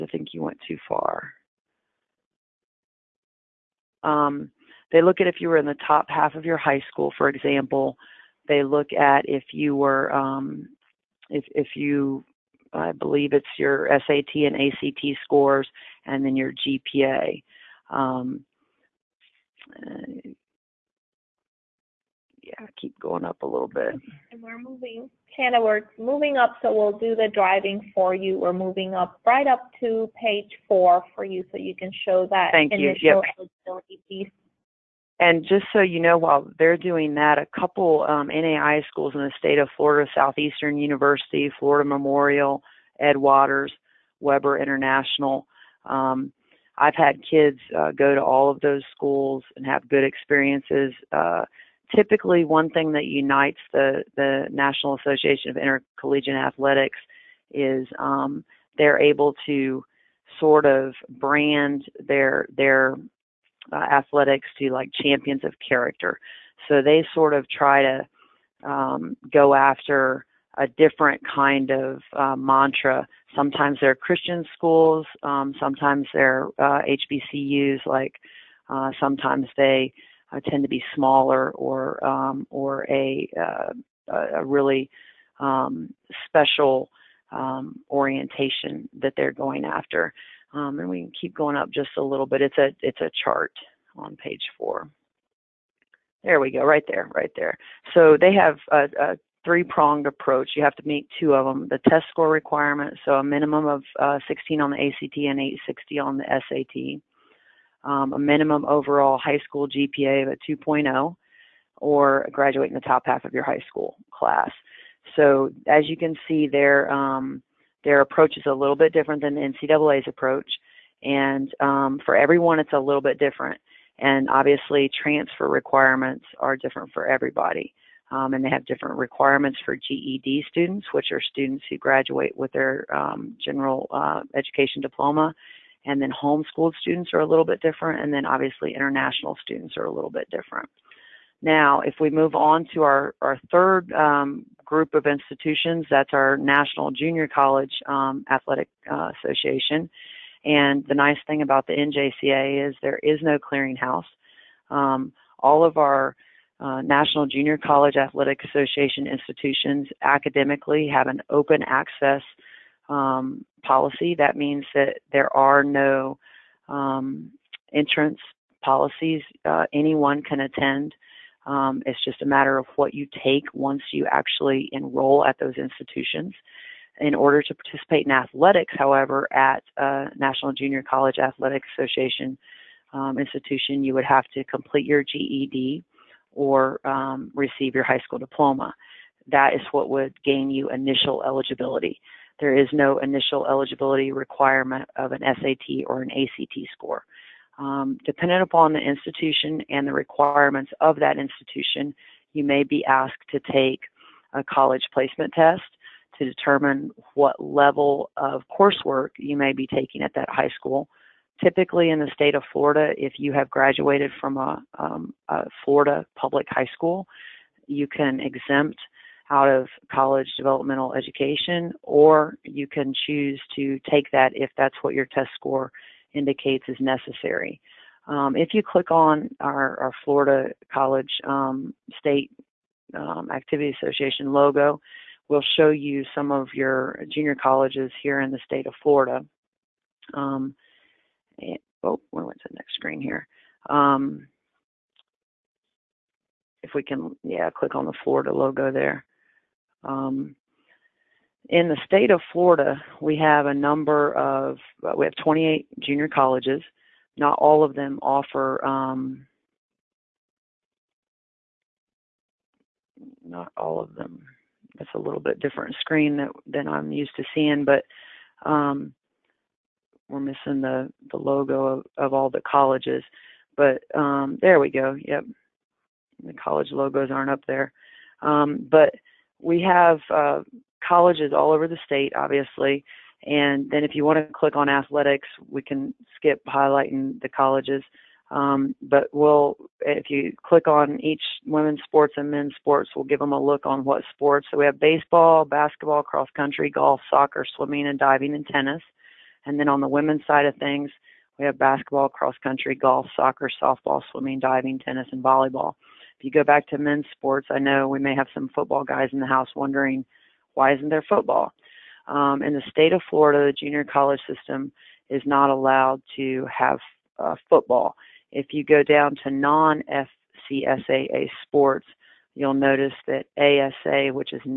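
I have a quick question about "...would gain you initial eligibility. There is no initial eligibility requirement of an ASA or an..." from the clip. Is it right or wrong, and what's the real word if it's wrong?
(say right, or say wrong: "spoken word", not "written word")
wrong: "SAT", not "ASA".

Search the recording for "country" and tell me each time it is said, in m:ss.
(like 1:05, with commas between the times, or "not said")
4:56, 5:02.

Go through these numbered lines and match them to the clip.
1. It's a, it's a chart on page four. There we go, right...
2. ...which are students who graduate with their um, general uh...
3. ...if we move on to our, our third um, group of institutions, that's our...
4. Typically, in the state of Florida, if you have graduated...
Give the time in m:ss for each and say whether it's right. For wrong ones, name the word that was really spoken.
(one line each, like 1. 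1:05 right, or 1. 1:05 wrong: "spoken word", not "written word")
1. 1:32 right
2. 2:10 right
3. 2:21 right
4. 3:31 right.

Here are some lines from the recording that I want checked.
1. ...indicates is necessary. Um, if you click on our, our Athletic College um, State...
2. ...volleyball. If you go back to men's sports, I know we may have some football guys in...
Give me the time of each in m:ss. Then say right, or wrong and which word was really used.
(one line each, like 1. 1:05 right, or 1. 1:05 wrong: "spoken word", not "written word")
1. 3:46 wrong: "Florida", not "Athletic"
2. 5:05 right.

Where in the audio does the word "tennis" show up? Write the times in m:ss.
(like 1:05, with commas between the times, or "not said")
4:58, 5:04.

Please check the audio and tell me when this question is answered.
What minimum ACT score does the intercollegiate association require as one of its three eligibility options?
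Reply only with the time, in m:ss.
1:44.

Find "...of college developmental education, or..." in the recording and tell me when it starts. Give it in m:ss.
3:39.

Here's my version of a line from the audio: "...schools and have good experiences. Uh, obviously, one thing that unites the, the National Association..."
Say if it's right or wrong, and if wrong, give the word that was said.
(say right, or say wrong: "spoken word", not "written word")
wrong: "typically", not "obviously".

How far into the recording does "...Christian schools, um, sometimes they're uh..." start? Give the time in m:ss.
1:13.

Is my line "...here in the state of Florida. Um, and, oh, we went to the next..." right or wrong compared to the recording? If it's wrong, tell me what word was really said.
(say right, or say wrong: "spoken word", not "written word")
right.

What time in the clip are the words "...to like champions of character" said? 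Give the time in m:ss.
1:04.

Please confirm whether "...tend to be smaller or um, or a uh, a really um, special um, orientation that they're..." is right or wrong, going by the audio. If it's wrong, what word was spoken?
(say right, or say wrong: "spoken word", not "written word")
right.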